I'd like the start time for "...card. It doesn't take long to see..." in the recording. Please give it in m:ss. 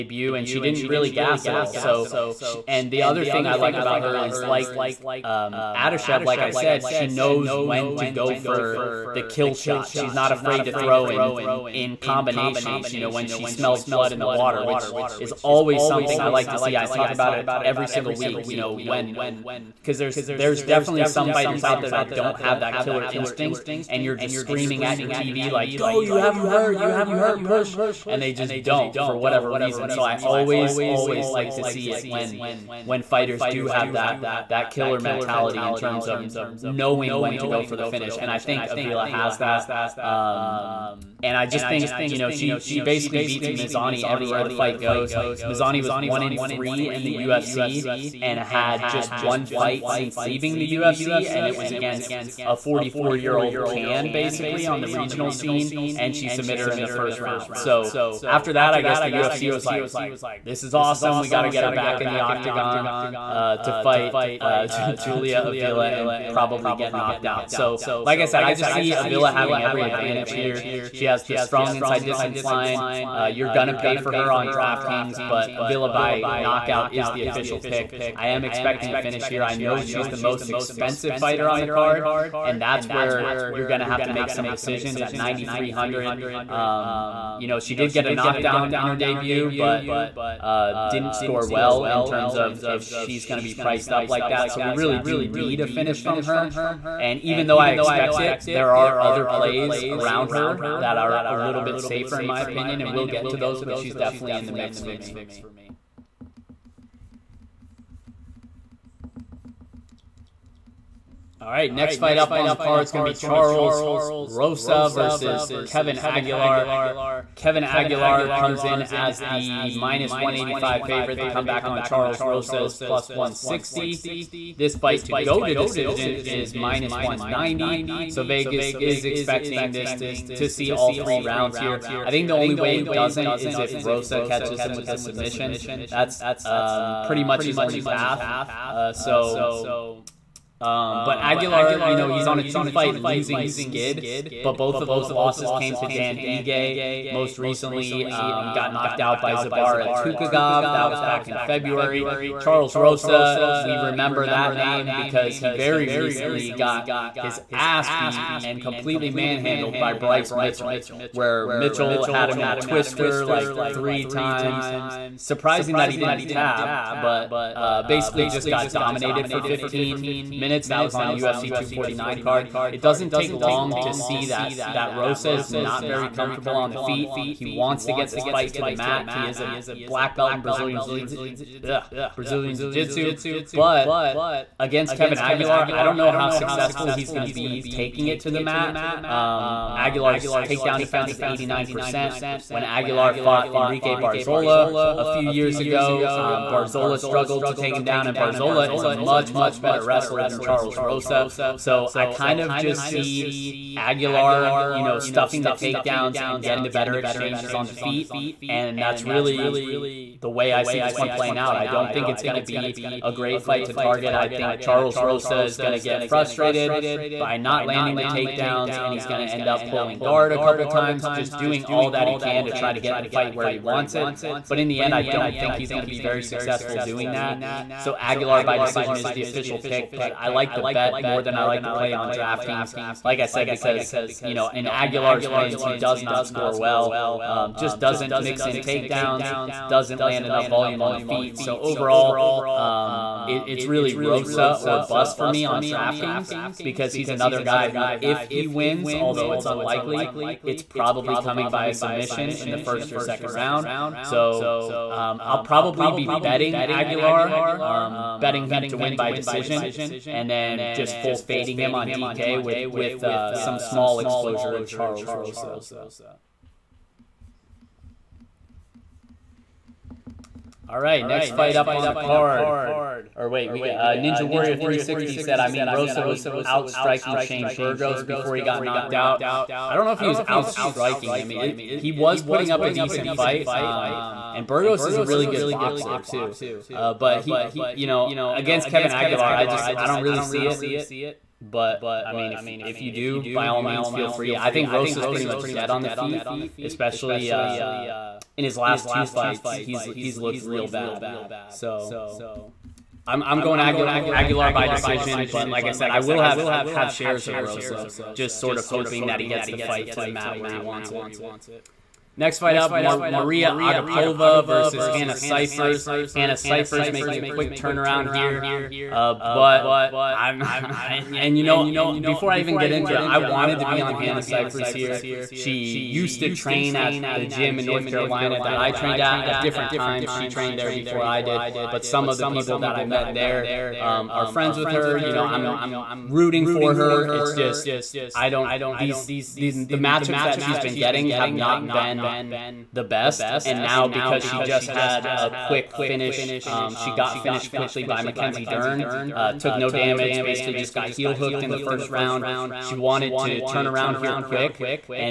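2:52.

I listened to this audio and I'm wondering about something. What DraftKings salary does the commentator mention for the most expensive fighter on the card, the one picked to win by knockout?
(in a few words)
9,300.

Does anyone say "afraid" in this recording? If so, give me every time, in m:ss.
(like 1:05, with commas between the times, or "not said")
0:10.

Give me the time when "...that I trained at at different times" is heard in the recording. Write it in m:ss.
5:28.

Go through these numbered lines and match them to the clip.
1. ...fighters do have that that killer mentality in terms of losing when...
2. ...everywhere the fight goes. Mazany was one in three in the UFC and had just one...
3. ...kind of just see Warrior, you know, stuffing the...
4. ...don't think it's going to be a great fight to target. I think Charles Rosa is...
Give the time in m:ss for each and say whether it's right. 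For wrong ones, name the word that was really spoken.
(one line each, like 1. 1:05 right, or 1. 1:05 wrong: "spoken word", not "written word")
1. 0:33 wrong: "knowing", not "losing"
2. 0:44 right
3. 3:22 wrong: "Aguilar", not "Warrior"
4. 3:31 right.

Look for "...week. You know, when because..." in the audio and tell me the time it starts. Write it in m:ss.
0:18.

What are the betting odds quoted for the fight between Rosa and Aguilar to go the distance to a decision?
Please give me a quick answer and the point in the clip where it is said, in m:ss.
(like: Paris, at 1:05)
-190, at 2:06.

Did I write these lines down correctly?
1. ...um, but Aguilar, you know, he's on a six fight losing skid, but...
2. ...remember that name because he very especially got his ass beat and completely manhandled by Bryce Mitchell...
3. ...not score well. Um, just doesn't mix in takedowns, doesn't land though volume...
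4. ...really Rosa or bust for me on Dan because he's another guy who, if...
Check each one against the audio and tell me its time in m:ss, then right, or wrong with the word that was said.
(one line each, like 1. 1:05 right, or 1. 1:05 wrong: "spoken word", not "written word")
1. 2:20 wrong: "two", not "six"
2. 2:33 wrong: "recently", not "especially"
3. 3:56 wrong: "enough", not "though"
4. 4:03 wrong: "DraftKings", not "Dan".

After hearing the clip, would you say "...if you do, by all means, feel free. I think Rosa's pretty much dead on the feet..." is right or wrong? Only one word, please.
right.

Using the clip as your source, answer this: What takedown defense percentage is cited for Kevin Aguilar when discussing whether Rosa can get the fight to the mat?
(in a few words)
89 percent.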